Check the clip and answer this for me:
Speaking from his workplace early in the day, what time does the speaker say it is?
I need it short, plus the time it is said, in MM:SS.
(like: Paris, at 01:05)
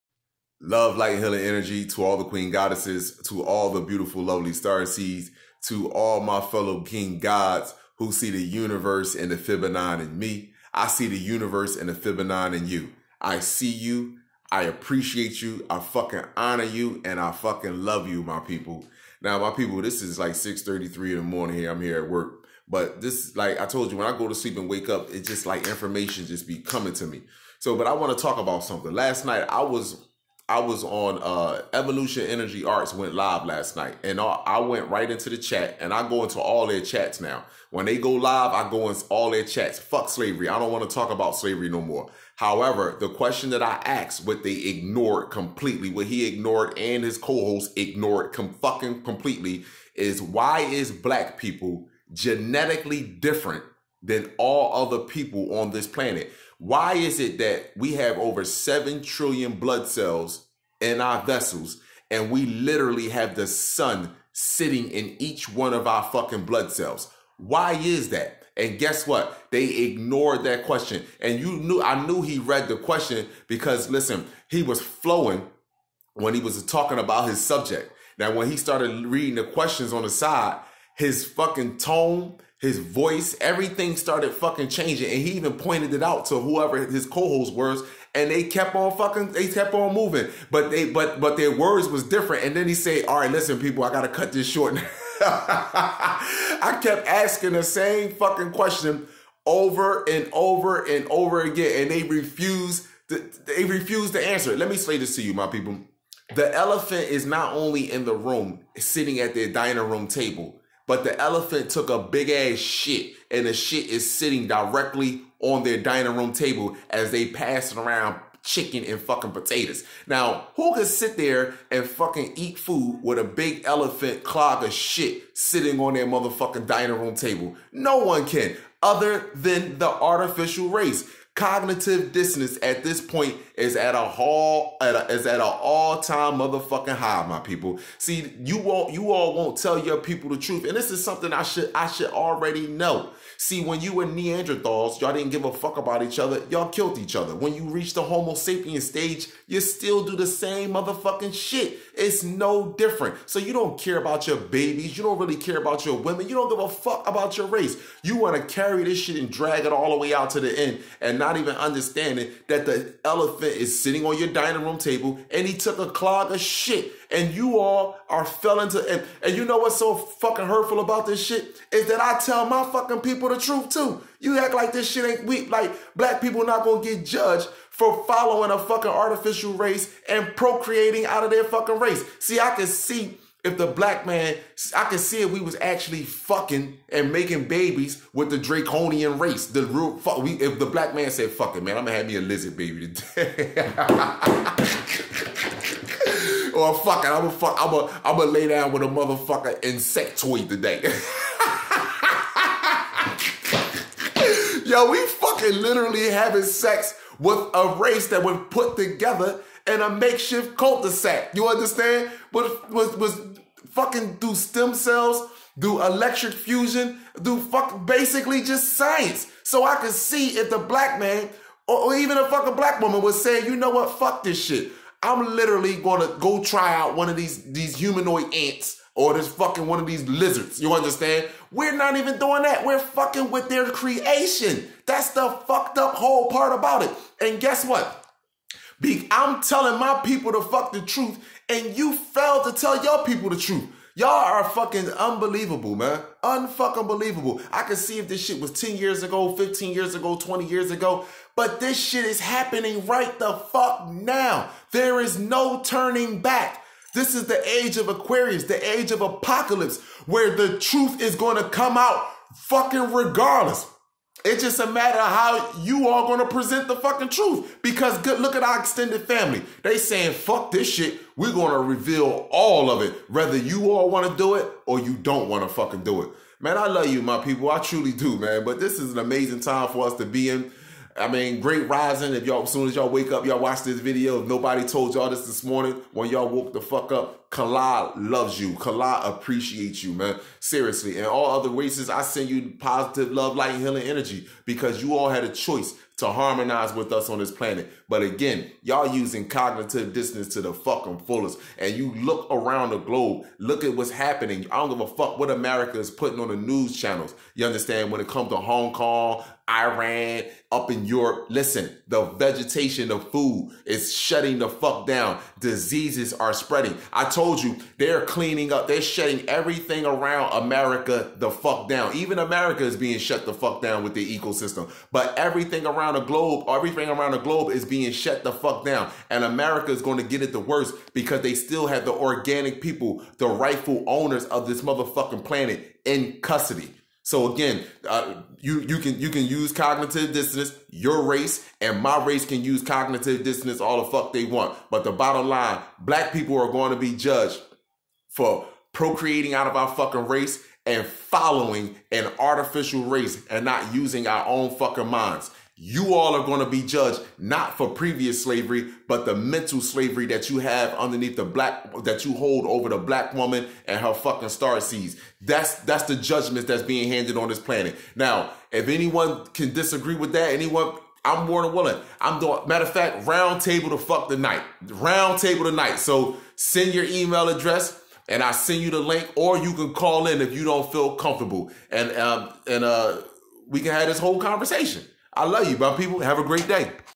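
6:33, at 00:20.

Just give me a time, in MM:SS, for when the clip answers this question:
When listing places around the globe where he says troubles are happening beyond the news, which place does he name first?
05:08.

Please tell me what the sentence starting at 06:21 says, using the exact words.
And um, and uh we can have this whole conversation.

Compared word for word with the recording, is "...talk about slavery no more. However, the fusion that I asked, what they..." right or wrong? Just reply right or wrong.
wrong.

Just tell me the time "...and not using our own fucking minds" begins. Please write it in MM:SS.
05:53.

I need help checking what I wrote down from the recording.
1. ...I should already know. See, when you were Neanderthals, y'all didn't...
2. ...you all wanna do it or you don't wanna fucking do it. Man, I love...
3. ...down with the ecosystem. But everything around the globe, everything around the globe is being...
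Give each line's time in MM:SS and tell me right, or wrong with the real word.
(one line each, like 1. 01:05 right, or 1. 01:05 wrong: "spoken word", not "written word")
1. 02:21 right
2. 04:33 right
3. 05:23 right.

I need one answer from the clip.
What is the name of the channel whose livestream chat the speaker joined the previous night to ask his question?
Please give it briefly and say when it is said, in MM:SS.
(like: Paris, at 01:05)
Evolution Energy Arts, at 00:31.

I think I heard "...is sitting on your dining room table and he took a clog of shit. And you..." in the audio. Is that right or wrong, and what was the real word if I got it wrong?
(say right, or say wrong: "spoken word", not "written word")
right.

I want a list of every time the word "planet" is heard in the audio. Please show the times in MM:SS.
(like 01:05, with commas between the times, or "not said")
00:55, 04:57, 05:35, 06:07.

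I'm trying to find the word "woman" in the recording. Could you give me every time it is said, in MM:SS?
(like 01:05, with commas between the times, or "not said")
03:42, 06:03.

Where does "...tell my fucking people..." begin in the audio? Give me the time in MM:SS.
02:52.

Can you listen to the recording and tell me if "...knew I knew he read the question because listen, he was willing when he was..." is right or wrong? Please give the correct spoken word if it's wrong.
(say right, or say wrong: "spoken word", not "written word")
wrong: "flowing", not "willing".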